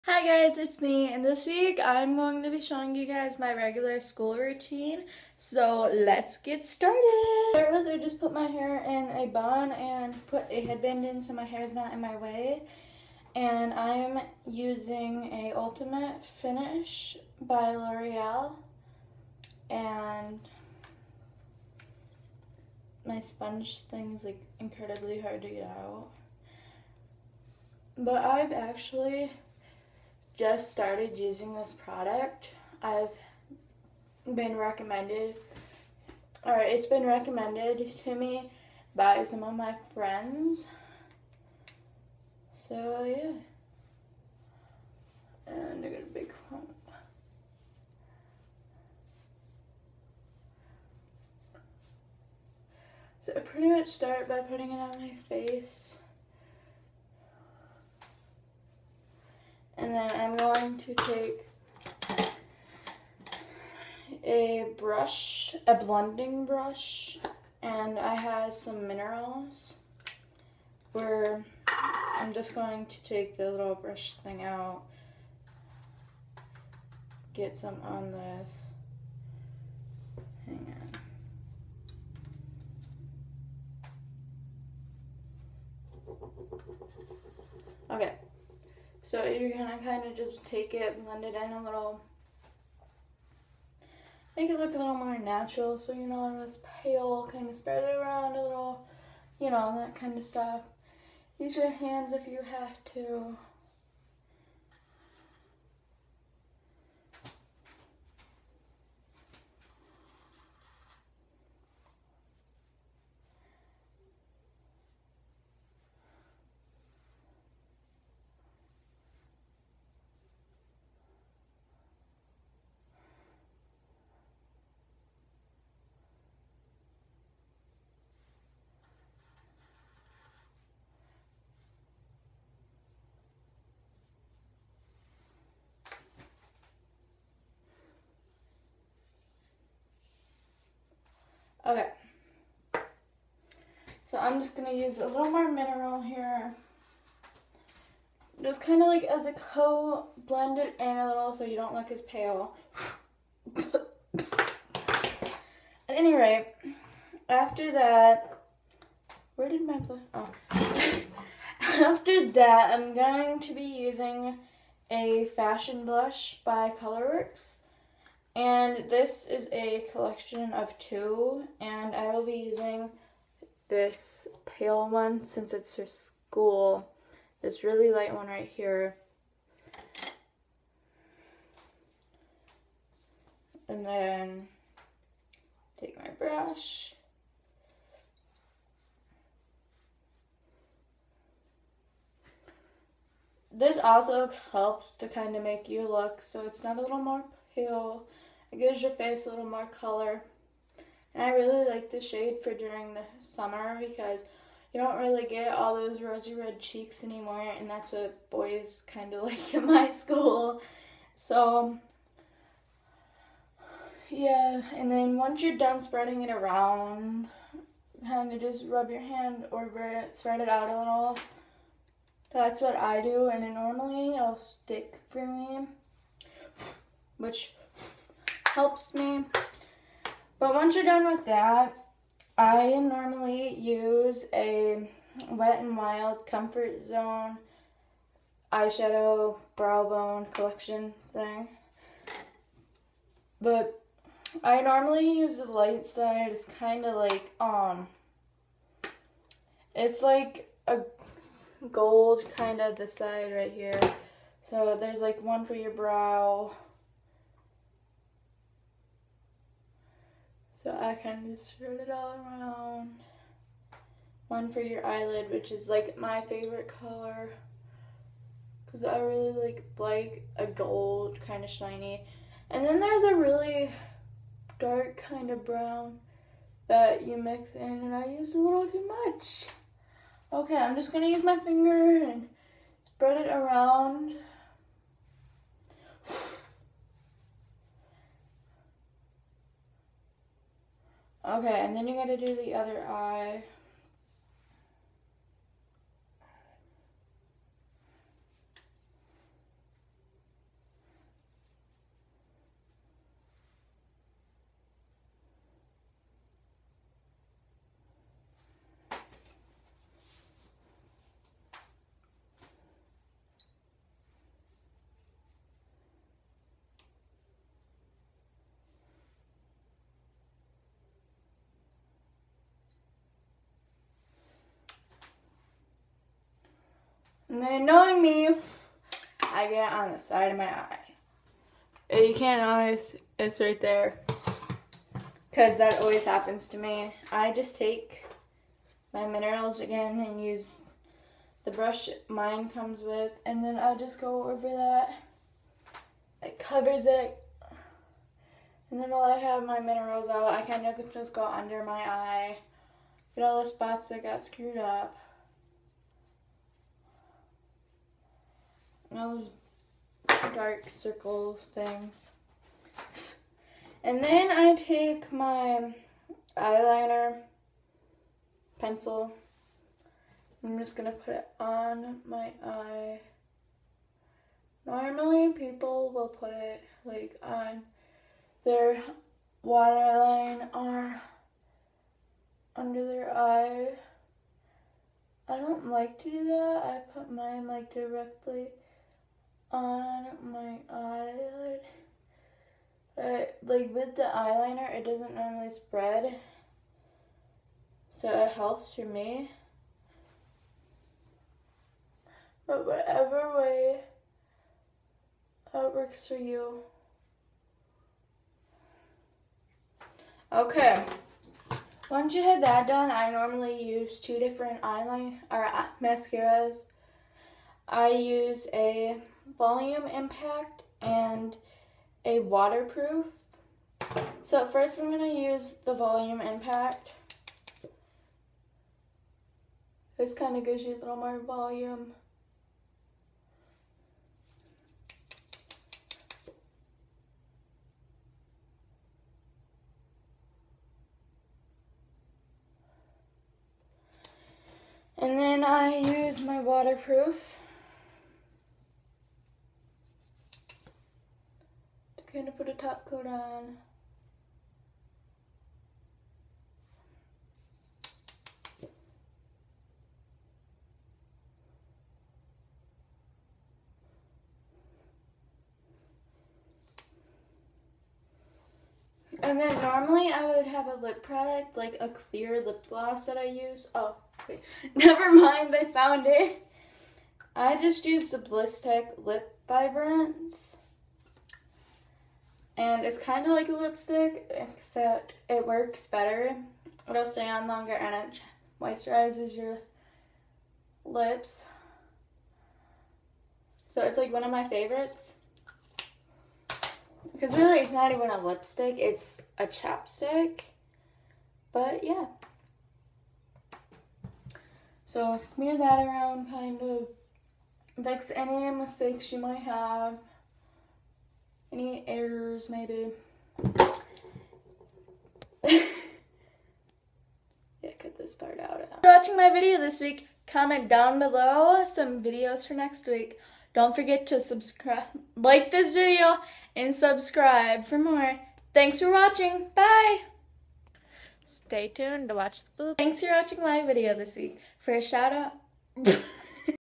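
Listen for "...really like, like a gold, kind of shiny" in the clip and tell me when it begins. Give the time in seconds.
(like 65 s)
268 s.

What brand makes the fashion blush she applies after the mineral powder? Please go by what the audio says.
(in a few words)
Colorworks.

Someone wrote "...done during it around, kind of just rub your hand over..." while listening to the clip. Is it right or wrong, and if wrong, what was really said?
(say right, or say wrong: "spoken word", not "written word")
wrong: "spreading", not "during".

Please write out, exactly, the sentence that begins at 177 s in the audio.
This really light one right here.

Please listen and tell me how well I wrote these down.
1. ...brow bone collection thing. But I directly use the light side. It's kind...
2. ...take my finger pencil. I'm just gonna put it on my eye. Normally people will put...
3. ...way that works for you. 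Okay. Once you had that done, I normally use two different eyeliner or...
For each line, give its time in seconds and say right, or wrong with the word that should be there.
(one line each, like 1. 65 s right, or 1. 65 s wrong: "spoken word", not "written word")
1. 239 s wrong: "normally", not "directly"
2. 364 s wrong: "eyeliner", not "finger"
3. 403 s right.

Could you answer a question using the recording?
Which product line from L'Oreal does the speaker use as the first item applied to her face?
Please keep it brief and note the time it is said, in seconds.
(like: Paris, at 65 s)
Ultimate Finish, at 15 s.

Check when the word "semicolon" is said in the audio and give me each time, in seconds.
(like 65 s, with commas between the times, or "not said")
not said.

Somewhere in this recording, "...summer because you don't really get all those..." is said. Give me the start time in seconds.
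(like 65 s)
203 s.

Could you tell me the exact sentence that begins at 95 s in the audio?
So you know, this pale, kind of spread it around a little, you know, that kind of stuff.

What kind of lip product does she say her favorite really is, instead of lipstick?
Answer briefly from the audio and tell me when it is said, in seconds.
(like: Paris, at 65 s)
chapstick, at 499 s.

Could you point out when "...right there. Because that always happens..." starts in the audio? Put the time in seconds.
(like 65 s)
333 s.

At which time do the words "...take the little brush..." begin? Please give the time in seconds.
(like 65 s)
73 s.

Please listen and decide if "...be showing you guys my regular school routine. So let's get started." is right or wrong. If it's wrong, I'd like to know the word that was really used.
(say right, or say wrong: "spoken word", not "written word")
right.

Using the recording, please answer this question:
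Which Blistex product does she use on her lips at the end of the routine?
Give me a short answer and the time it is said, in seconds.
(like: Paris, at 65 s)
Lip Vibrance, at 478 s.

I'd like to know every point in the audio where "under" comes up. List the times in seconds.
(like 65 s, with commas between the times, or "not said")
351 s, 382 s.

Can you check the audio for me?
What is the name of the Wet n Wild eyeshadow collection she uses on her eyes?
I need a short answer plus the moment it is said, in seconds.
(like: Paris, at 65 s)
Comfort Zone, at 236 s.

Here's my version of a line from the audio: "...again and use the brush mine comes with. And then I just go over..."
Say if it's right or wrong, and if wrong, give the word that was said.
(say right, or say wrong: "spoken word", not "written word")
right.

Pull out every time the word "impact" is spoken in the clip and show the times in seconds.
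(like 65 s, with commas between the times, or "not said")
419 s, 426 s.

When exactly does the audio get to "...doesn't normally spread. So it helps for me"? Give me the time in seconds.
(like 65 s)
394 s.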